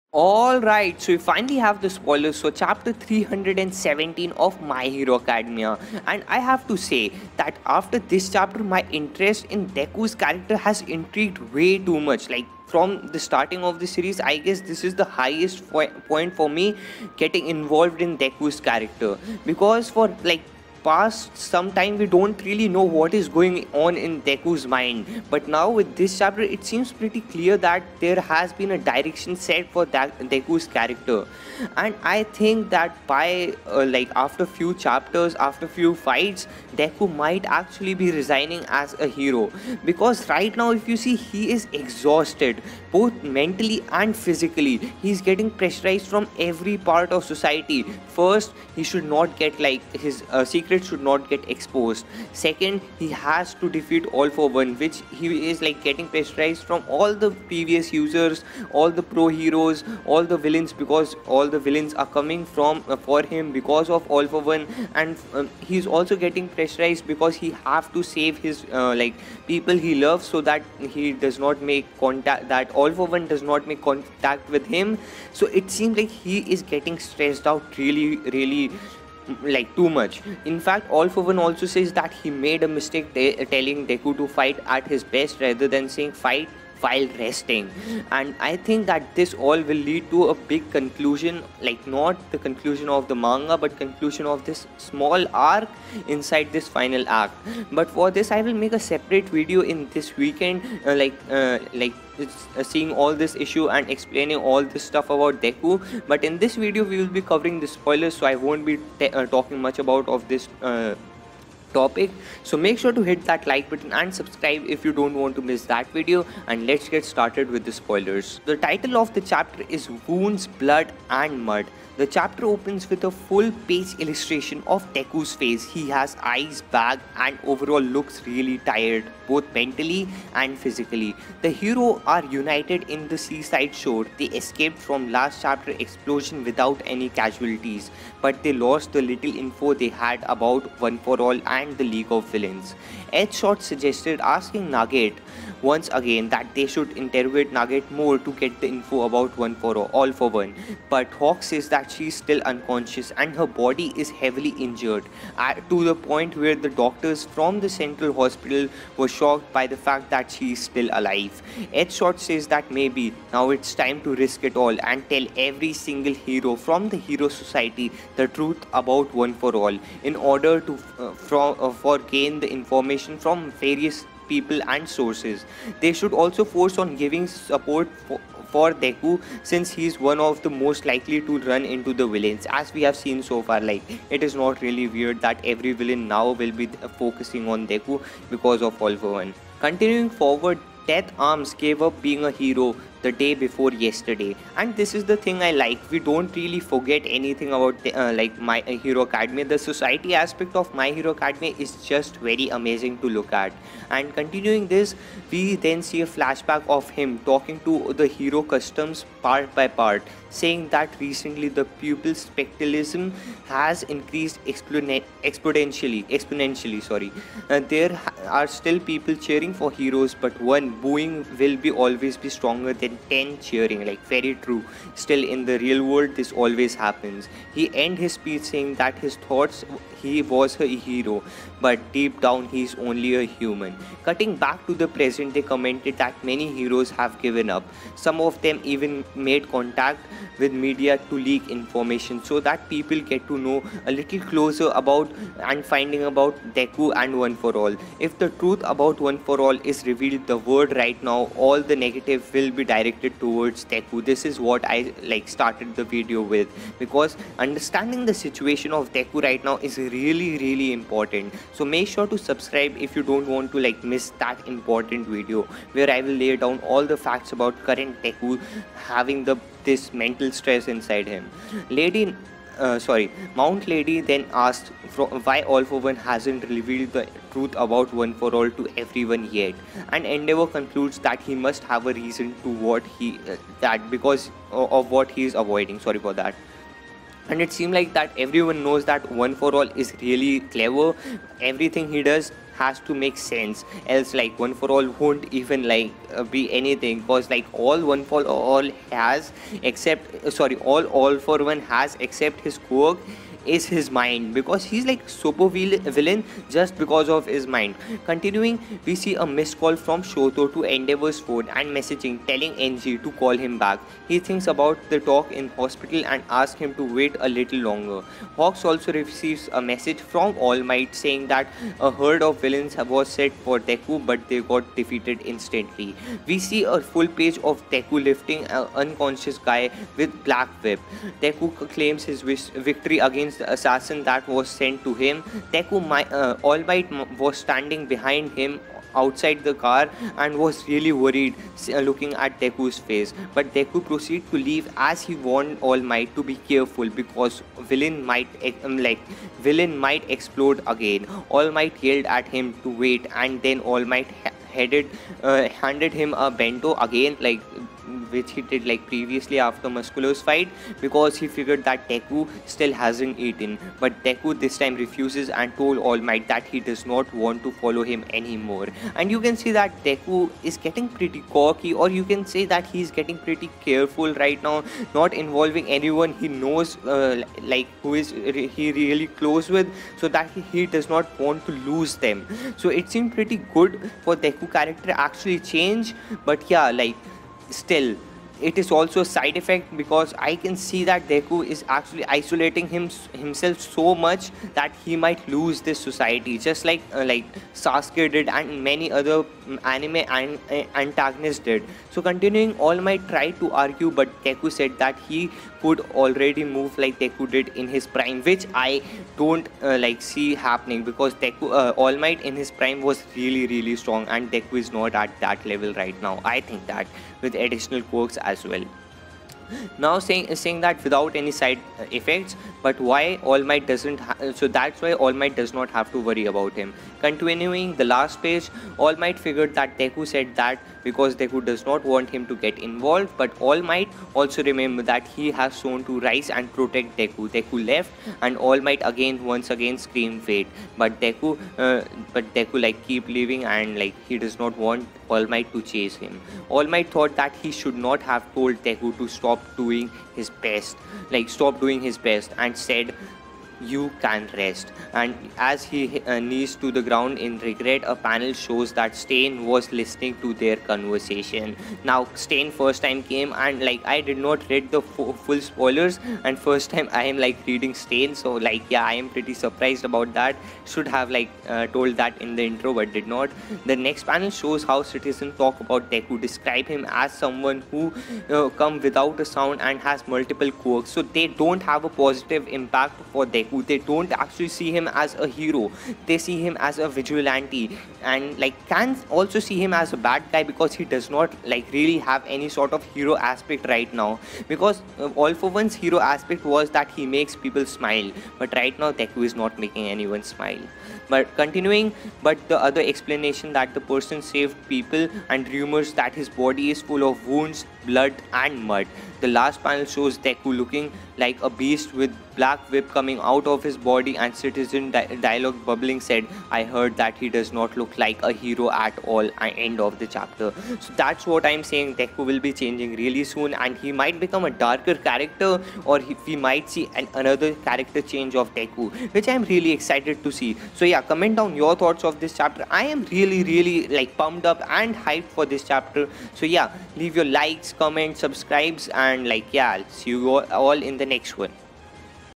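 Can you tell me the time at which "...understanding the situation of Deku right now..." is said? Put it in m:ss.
4:17.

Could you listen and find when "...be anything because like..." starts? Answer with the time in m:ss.
4:56.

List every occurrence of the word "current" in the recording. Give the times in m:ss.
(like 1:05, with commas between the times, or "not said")
4:27.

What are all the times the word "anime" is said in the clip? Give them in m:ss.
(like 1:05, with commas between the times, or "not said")
6:39.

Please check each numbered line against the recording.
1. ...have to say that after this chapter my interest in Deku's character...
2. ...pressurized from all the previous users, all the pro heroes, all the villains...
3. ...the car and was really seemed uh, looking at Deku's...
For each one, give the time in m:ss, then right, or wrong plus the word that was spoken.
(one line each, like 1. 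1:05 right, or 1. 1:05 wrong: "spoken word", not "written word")
1. 0:06 right
2. 0:56 right
3. 5:39 wrong: "worried", not "seemed".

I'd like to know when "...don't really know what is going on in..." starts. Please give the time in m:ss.
0:22.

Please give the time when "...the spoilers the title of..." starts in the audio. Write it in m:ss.
1:57.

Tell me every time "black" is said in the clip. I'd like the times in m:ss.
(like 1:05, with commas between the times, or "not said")
5:30, 8:32.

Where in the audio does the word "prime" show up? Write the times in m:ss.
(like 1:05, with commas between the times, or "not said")
6:47, 6:52.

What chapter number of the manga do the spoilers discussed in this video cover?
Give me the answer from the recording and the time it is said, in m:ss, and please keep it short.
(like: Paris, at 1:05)
317, at 0:02.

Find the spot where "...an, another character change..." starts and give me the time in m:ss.
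8:46.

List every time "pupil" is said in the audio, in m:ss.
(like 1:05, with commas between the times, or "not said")
3:31.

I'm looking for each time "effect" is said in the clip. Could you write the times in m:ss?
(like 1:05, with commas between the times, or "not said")
6:29, 7:01.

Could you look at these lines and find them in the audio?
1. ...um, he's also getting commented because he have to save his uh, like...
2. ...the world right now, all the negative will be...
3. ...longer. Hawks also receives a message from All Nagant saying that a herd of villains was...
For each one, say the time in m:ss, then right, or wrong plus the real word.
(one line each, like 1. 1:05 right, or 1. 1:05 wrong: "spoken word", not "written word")
1. 1:05 wrong: "pressurized", not "commented"
2. 4:10 right
3. 5:17 wrong: "Might", not "Nagant".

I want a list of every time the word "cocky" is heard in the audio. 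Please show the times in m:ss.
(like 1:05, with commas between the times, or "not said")
6:11.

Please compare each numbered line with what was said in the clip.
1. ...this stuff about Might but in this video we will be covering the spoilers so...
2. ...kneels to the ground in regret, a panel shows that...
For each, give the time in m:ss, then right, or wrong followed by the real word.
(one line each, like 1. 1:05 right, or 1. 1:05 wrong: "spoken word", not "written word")
1. 1:44 wrong: "Deku", not "Might"
2. 7:36 right.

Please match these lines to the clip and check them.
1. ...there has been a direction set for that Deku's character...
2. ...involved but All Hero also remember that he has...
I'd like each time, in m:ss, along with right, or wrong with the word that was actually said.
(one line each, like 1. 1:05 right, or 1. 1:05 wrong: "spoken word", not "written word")
1. 0:27 right
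2. 7:12 wrong: "Might", not "Hero".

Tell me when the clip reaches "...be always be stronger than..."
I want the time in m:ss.
3:41.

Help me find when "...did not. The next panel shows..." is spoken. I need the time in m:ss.
7:52.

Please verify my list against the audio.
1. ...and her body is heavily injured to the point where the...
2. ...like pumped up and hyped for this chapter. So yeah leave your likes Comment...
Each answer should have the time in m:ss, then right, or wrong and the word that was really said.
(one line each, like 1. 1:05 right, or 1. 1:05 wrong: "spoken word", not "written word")
1. 2:33 right
2. 8:53 right.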